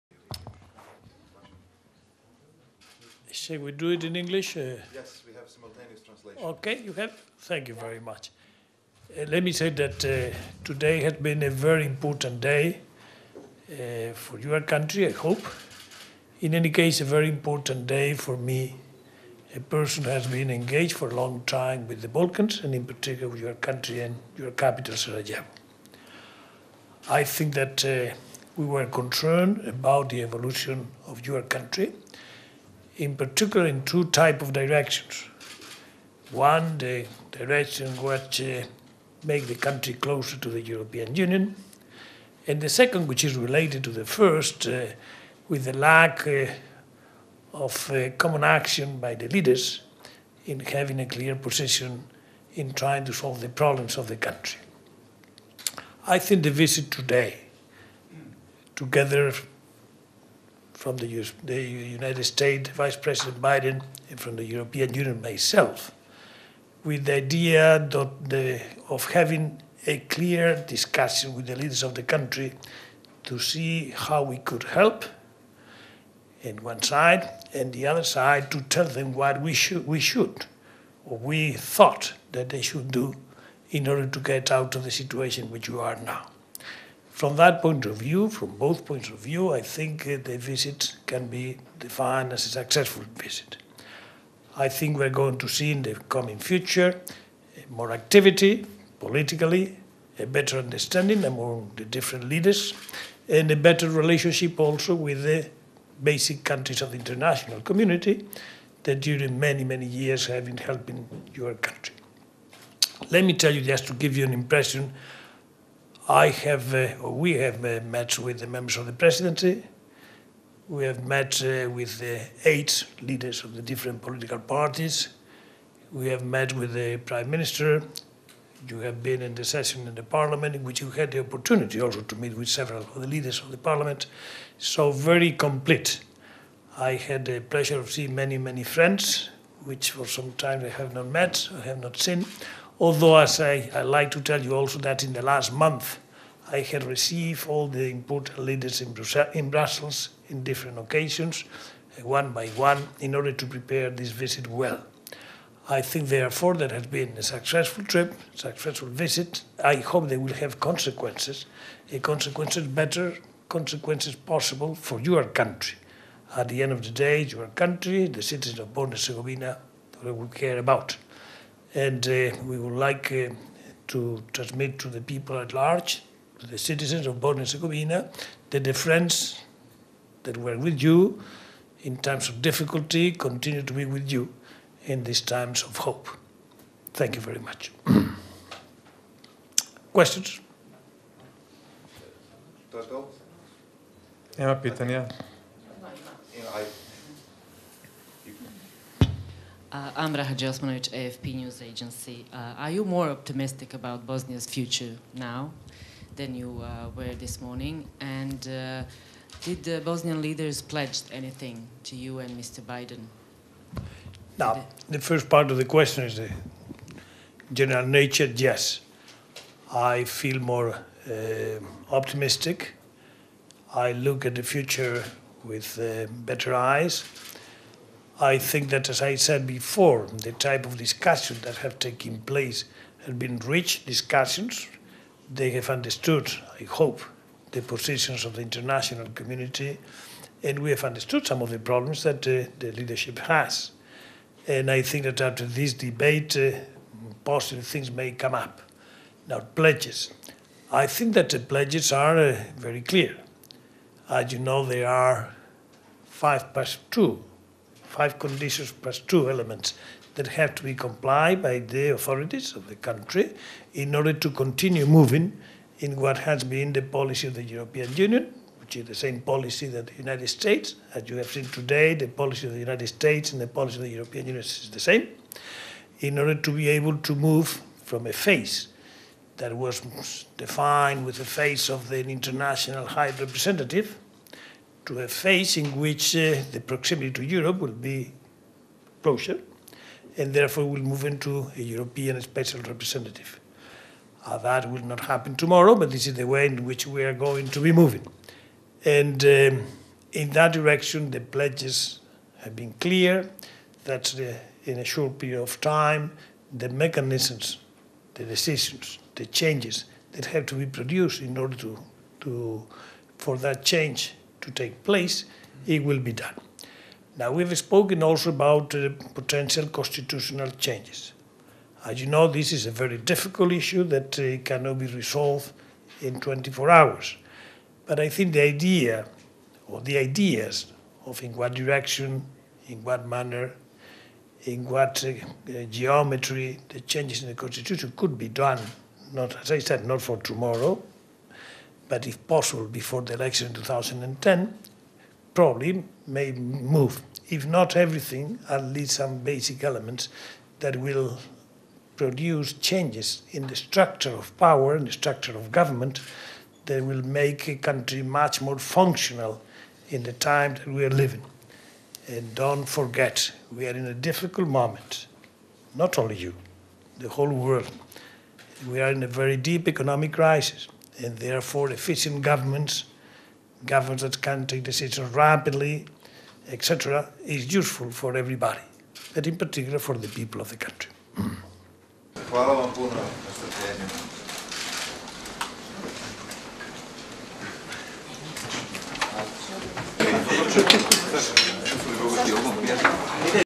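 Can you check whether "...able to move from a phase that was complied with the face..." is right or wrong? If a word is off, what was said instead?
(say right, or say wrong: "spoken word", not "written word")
wrong: "defined", not "complied".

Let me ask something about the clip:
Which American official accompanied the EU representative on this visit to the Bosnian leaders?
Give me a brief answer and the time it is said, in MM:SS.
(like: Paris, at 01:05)
Vice President Biden, at 01:02.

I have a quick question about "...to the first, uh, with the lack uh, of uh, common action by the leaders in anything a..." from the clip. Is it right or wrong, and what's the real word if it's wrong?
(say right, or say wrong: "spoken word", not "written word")
wrong: "having", not "anything".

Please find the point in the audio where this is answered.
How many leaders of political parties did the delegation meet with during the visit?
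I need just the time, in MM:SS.
02:02.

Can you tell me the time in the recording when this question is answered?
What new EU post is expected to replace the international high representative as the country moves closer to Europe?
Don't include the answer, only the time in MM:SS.
04:51.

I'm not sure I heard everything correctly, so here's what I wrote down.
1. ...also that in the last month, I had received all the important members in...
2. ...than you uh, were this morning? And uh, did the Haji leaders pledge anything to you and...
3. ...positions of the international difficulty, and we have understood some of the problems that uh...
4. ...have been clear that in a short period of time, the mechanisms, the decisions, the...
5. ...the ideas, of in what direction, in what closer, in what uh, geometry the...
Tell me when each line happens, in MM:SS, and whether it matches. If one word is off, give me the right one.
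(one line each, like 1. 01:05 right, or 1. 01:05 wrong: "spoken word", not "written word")
1. 02:24 wrong: "leaders", not "members"
2. 03:26 wrong: "Bosnian", not "Haji"
3. 03:57 wrong: "community", not "difficulty"
4. 05:02 right
5. 05:29 wrong: "manner", not "closer".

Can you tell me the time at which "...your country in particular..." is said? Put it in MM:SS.
00:31.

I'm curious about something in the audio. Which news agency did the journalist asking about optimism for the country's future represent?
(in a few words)
AFP.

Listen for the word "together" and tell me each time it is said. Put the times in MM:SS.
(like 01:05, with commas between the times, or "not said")
00:58.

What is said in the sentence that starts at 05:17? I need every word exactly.
Now, we've spoken also about uh, potential constitutional changes.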